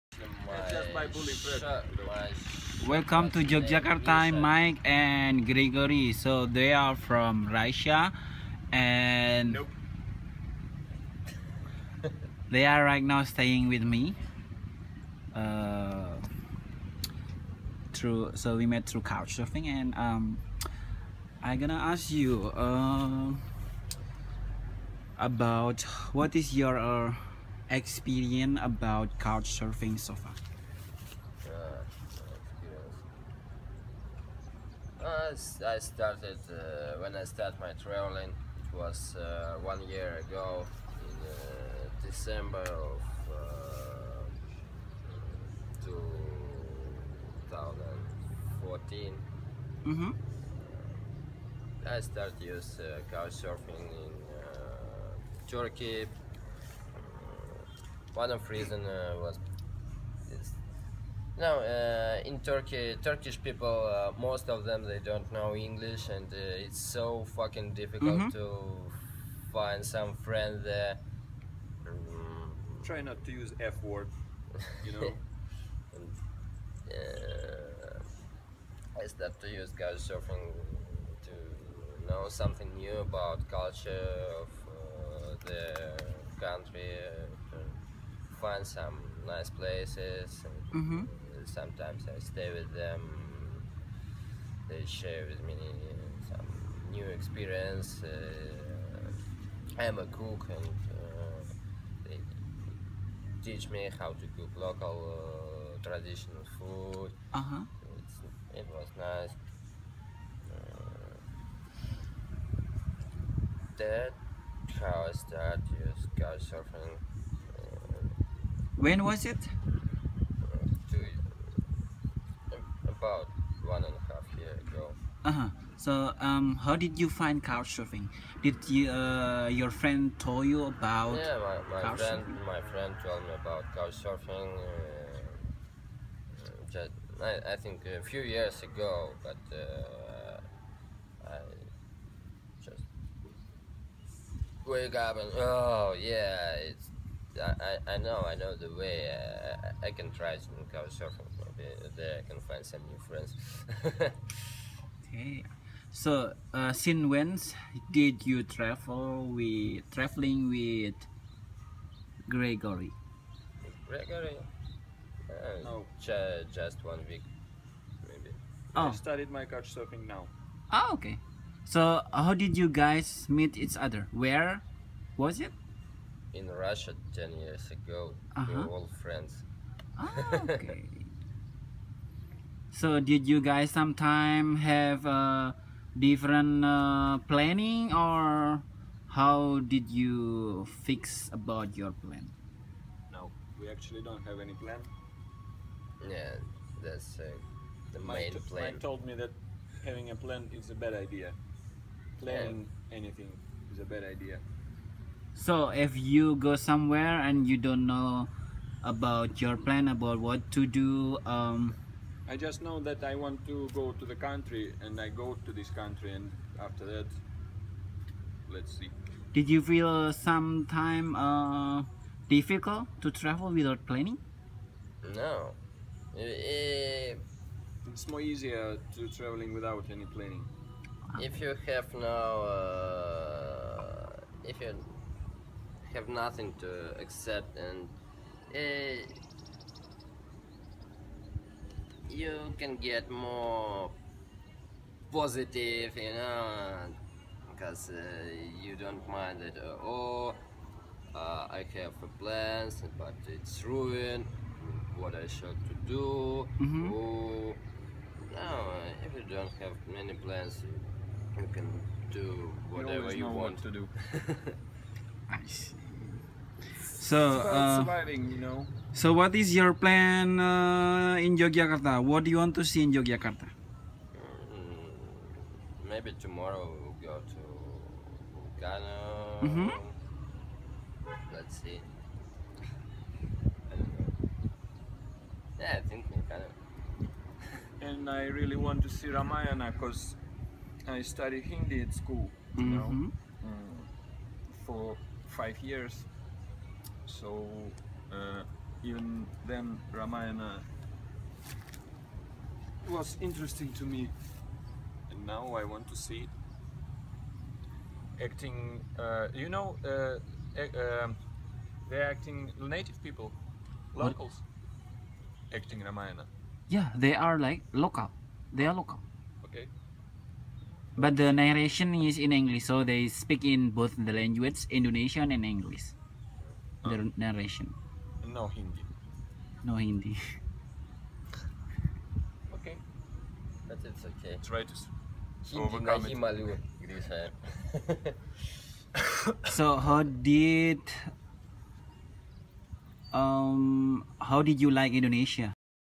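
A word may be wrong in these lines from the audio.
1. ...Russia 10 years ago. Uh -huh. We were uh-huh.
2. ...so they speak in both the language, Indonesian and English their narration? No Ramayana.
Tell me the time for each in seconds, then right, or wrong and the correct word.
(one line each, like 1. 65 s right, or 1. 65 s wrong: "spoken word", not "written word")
1. 176 s right
2. 322 s wrong: "Hindi", not "Ramayana".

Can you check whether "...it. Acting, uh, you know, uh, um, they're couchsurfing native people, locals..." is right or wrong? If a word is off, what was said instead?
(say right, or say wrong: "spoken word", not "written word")
wrong: "acting", not "couchsurfing".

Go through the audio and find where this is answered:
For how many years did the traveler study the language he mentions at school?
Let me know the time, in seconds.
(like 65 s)
295 s.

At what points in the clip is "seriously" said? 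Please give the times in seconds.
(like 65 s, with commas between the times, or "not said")
not said.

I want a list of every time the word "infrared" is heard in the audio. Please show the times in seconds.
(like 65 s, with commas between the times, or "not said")
not said.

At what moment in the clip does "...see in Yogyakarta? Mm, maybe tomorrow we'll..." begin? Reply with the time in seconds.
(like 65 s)
272 s.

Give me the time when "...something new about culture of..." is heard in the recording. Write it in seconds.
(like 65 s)
82 s.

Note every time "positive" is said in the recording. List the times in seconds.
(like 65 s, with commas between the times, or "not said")
245 s.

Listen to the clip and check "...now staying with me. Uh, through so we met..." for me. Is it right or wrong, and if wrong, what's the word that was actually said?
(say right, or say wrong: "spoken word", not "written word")
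right.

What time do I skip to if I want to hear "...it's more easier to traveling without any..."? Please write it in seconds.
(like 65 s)
226 s.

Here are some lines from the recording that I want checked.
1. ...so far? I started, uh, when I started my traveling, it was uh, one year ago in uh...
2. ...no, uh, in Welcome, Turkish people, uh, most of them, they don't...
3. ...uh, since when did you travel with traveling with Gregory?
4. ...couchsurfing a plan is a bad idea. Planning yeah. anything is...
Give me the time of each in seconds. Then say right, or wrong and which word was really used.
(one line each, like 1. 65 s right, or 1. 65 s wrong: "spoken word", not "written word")
1. 29 s right
2. 61 s wrong: "Turkey", not "Welcome"
3. 156 s right
4. 199 s wrong: "having", not "couchsurfing".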